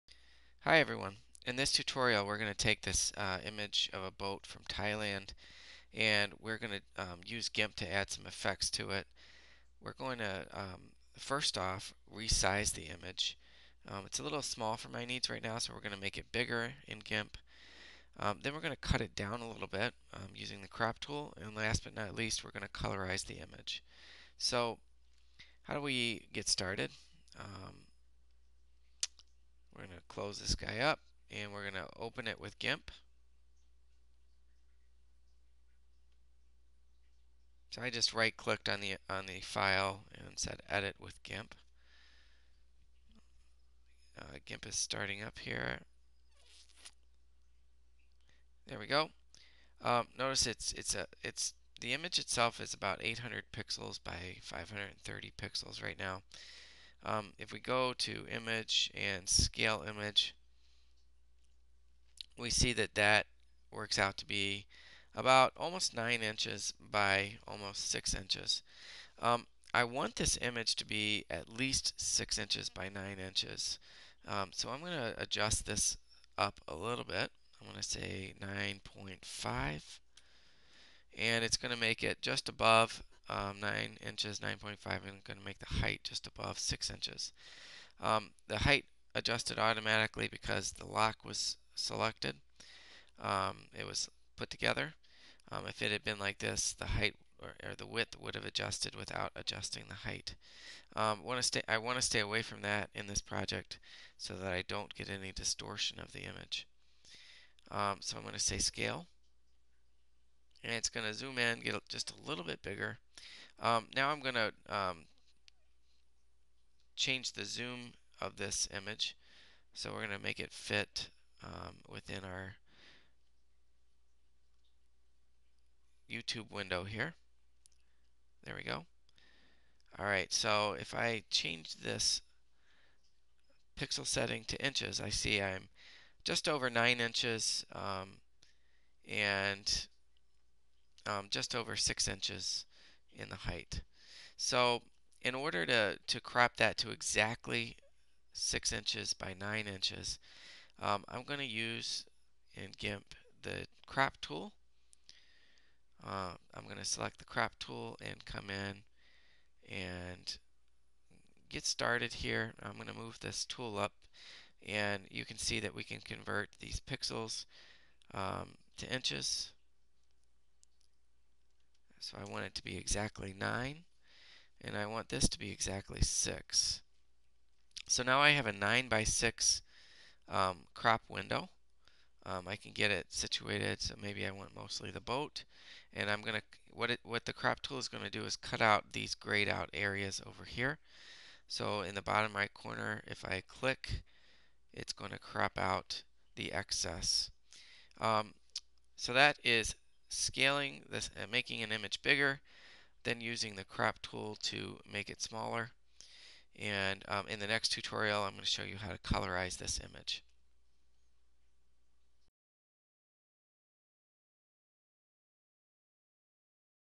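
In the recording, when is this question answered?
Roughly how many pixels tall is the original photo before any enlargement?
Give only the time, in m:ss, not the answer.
0:54.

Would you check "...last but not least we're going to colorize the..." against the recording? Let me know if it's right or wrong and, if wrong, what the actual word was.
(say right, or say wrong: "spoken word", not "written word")
right.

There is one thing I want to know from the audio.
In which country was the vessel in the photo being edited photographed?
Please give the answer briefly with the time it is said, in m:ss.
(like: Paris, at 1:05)
Thailand, at 0:04.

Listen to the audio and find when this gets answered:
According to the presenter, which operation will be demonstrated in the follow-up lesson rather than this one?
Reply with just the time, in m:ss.
3:28.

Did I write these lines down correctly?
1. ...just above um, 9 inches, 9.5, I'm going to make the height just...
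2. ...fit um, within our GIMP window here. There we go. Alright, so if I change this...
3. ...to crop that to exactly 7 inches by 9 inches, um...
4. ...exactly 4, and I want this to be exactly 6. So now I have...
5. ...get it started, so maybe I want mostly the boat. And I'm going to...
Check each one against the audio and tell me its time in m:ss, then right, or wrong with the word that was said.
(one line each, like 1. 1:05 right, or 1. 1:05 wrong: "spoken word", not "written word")
1. 1:22 right
2. 2:00 wrong: "YouTube", not "GIMP"
3. 2:26 wrong: "6", not "7"
4. 2:52 wrong: "9", not "4"
5. 3:02 wrong: "situated", not "started".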